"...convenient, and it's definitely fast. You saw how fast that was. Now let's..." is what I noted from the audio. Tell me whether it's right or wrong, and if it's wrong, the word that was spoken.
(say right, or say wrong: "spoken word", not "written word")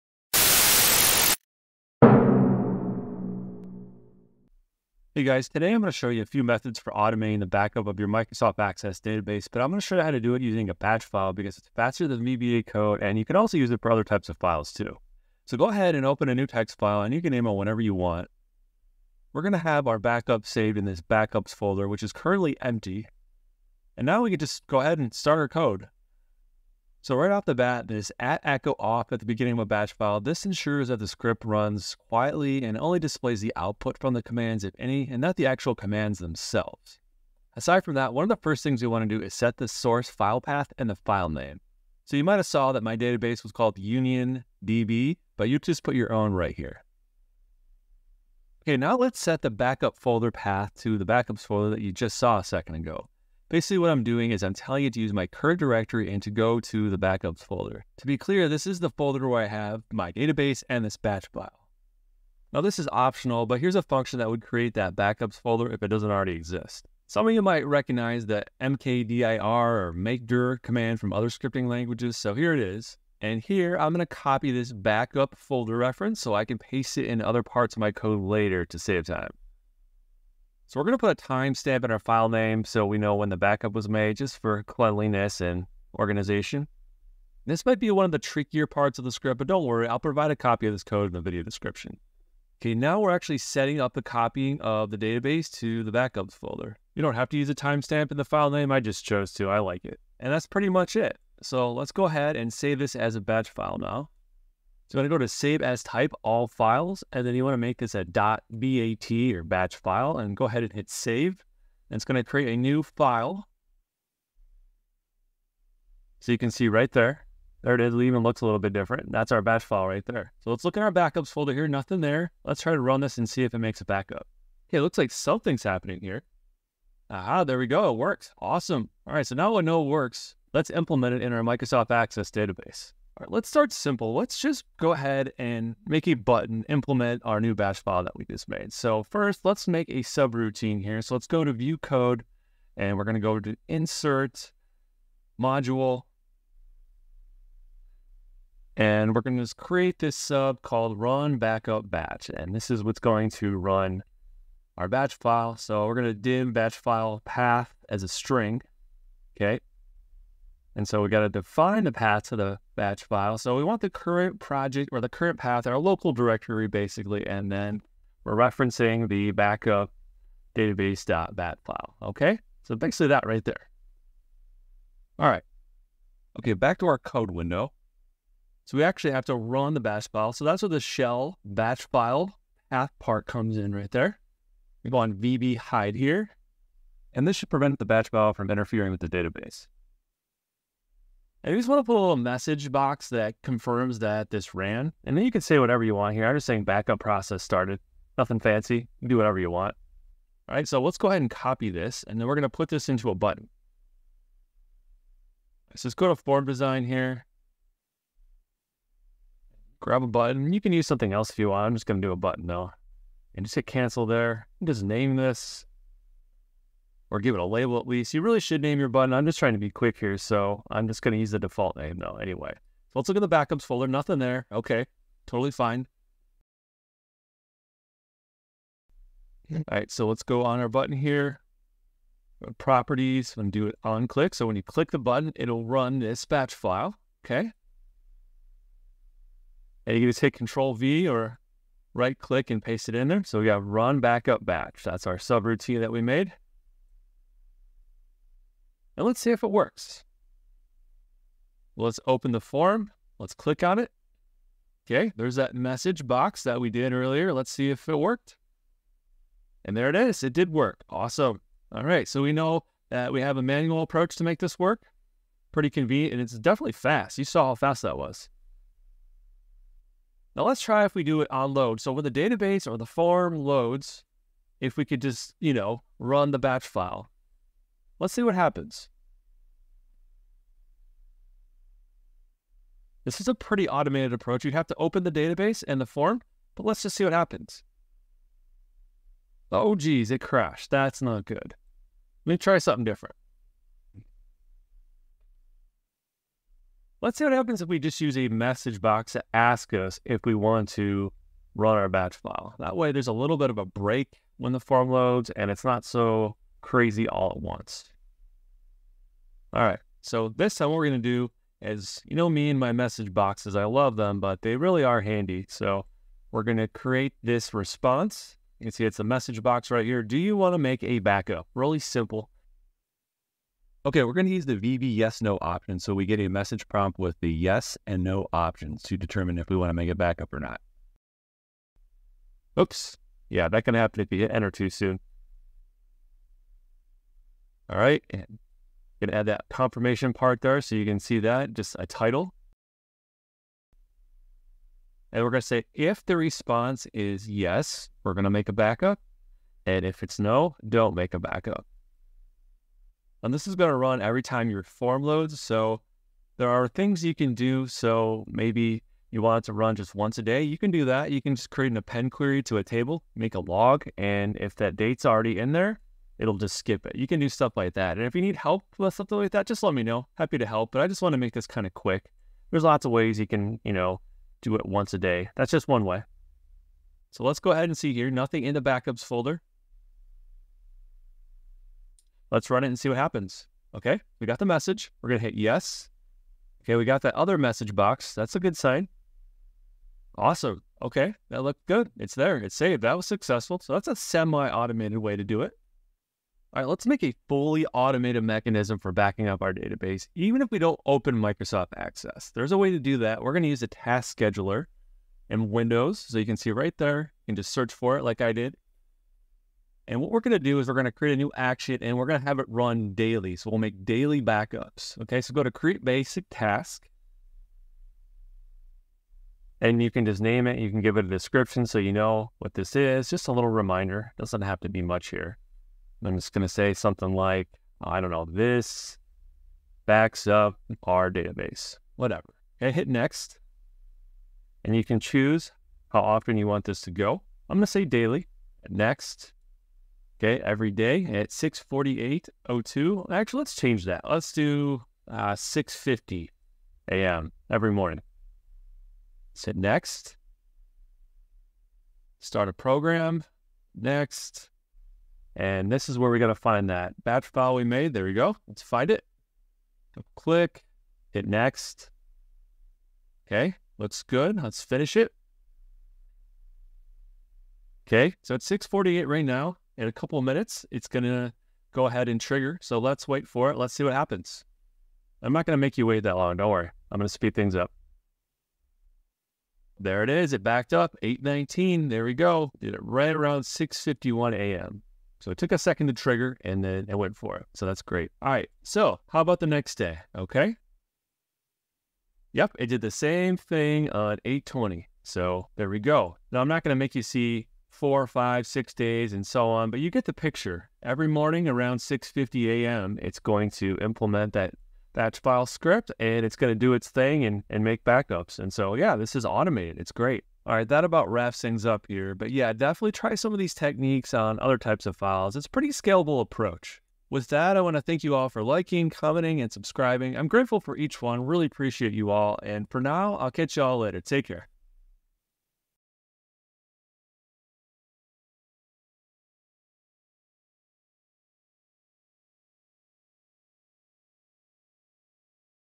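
right.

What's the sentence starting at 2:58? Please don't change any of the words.
So we actually have to run the batch file.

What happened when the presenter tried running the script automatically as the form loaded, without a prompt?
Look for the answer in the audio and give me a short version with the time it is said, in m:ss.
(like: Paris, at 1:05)
it crashed, at 4:50.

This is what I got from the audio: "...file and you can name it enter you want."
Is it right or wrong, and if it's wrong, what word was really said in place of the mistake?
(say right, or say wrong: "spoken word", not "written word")
wrong: "whenever", not "enter".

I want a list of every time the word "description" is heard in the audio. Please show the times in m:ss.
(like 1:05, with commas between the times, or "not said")
1:31, 7:01.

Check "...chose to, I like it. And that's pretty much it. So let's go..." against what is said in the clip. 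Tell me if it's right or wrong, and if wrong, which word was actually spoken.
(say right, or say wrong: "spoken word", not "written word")
right.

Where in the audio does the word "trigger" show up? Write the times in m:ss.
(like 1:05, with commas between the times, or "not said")
7:52, 8:05.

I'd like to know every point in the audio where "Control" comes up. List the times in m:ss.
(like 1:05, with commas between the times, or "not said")
4:00.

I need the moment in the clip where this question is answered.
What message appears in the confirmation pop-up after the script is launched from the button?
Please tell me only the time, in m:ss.
3:16.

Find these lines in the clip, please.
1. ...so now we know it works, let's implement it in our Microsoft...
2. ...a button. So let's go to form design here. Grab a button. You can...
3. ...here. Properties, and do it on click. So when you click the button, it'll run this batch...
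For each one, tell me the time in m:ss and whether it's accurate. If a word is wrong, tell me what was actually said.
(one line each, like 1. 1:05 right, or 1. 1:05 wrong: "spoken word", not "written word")
1. 2:09 right
2. 3:23 right
3. 3:50 right.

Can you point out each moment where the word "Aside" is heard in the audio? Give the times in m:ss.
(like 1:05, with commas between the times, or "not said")
0:37.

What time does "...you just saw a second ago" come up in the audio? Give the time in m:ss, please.
0:51.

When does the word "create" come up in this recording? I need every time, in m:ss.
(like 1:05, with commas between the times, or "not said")
1:04, 1:52, 2:29, 5:16, 6:01, 6:50, 6:55.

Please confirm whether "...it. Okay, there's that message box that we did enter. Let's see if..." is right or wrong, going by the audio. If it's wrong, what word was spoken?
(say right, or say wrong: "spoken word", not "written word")
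wrong: "earlier", not "enter".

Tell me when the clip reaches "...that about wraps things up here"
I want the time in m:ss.
8:30.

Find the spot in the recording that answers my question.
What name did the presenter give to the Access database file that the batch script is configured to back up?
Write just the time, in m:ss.
0:43.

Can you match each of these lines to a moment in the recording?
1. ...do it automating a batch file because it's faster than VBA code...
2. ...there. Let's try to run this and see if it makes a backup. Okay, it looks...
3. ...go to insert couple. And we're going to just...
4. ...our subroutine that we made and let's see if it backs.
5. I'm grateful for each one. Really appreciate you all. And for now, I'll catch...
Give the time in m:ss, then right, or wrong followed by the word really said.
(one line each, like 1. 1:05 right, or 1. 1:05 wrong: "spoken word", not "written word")
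1. 0:10 wrong: "using", not "automating"
2. 2:02 right
3. 2:23 wrong: "module", not "couple"
4. 4:05 wrong: "works", not "backs"
5. 8:40 right.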